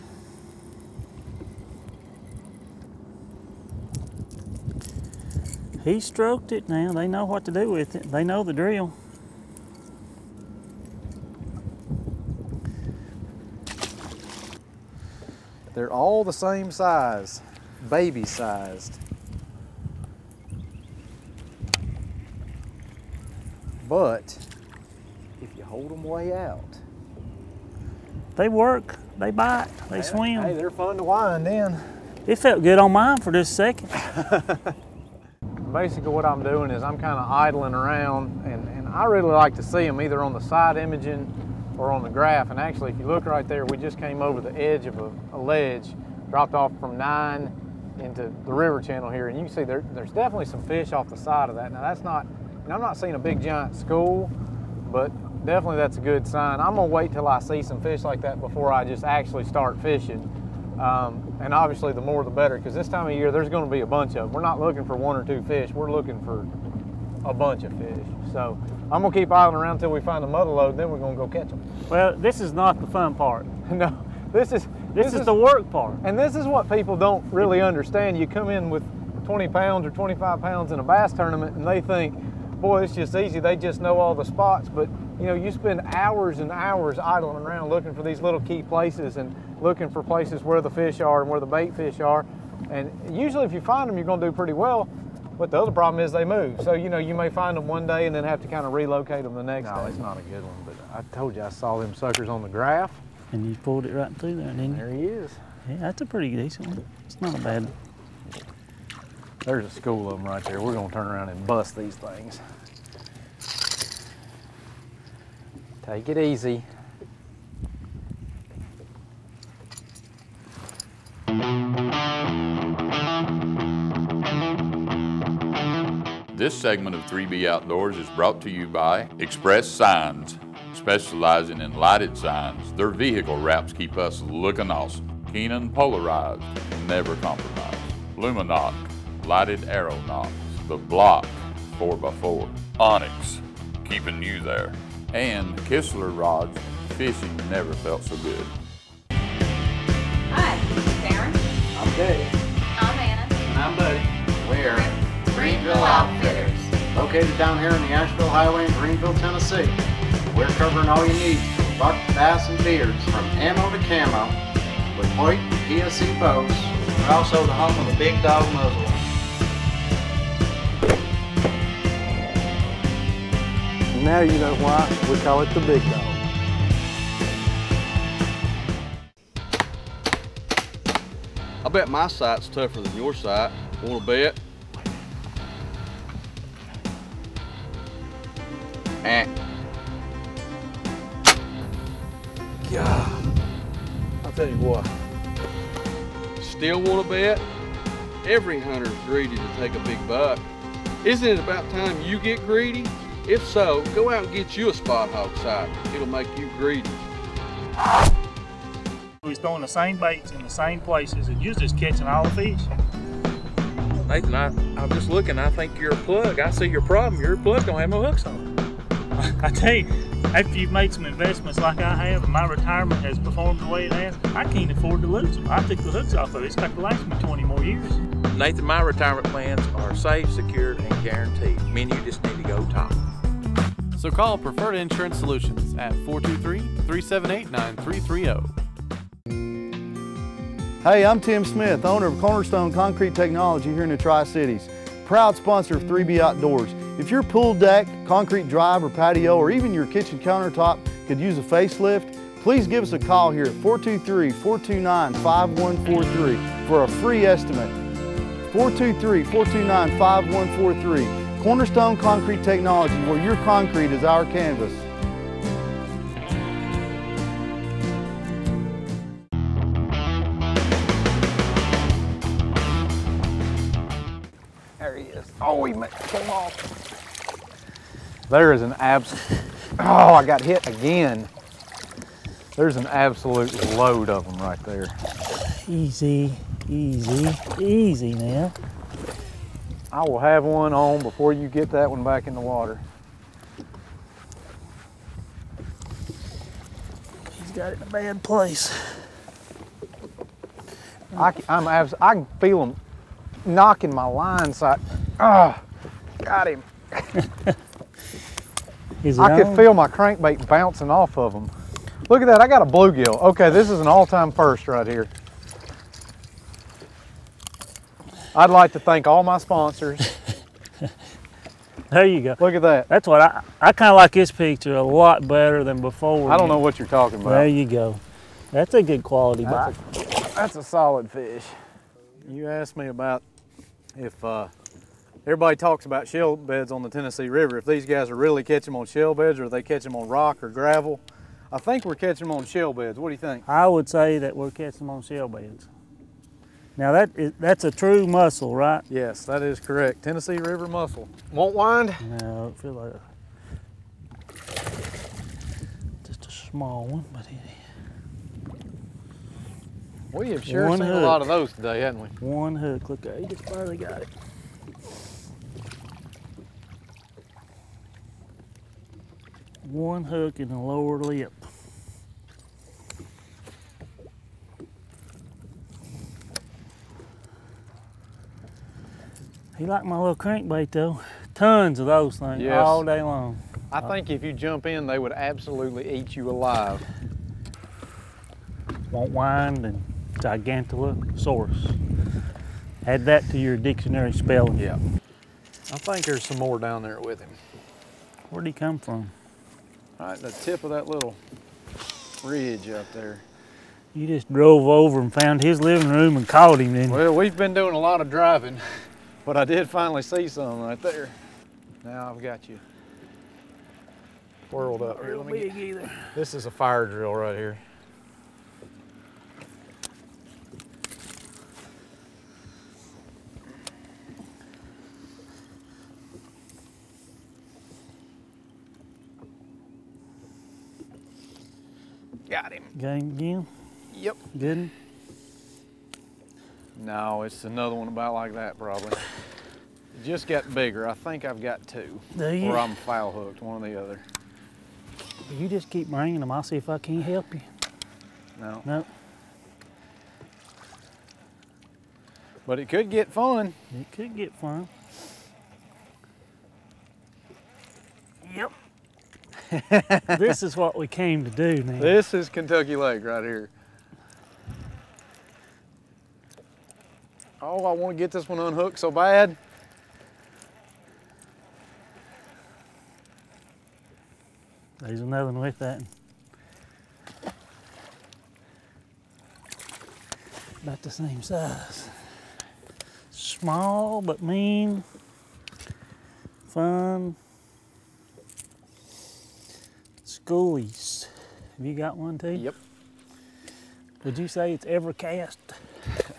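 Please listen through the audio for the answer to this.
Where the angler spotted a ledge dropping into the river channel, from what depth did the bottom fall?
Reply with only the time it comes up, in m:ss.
0:46.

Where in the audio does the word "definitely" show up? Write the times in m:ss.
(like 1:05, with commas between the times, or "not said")
0:50, 0:55.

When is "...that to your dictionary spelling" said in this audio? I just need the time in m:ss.
6:33.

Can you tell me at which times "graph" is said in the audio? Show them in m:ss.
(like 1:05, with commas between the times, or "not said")
0:42, 1:42.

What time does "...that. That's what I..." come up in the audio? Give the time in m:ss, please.
5:22.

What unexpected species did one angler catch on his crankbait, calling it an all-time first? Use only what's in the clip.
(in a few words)
Bluegill.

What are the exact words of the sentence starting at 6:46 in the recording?
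Well, we've been doing a lot of driving, but I did finally see some right there.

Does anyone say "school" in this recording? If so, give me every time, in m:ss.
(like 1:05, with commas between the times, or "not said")
0:53, 1:49.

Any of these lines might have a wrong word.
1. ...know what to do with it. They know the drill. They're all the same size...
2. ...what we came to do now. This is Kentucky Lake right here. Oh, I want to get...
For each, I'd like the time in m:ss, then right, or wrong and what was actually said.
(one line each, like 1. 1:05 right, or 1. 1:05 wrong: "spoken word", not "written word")
1. 0:07 right
2. 7:40 right.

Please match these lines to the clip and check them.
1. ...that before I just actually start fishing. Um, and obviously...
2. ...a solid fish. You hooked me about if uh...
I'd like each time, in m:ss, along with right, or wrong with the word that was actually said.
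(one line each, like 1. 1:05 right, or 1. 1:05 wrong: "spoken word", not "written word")
1. 0:58 right
2. 5:30 wrong: "asked", not "hooked".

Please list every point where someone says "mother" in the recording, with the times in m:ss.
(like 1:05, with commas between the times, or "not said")
1:10.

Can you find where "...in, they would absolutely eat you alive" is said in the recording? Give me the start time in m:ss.
6:24.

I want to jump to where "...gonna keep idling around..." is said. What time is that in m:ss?
1:09.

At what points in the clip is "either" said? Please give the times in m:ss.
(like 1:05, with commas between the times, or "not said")
0:39, 6:55.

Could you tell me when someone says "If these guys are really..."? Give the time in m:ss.
5:37.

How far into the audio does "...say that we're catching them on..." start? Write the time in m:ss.
5:43.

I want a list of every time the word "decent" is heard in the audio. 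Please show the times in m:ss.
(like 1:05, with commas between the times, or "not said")
1:46.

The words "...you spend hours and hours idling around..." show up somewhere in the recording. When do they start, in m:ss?
1:25.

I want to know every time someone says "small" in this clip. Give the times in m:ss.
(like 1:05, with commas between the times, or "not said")
5:56, 8:03.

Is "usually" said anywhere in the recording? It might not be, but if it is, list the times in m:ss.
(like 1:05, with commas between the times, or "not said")
1:33.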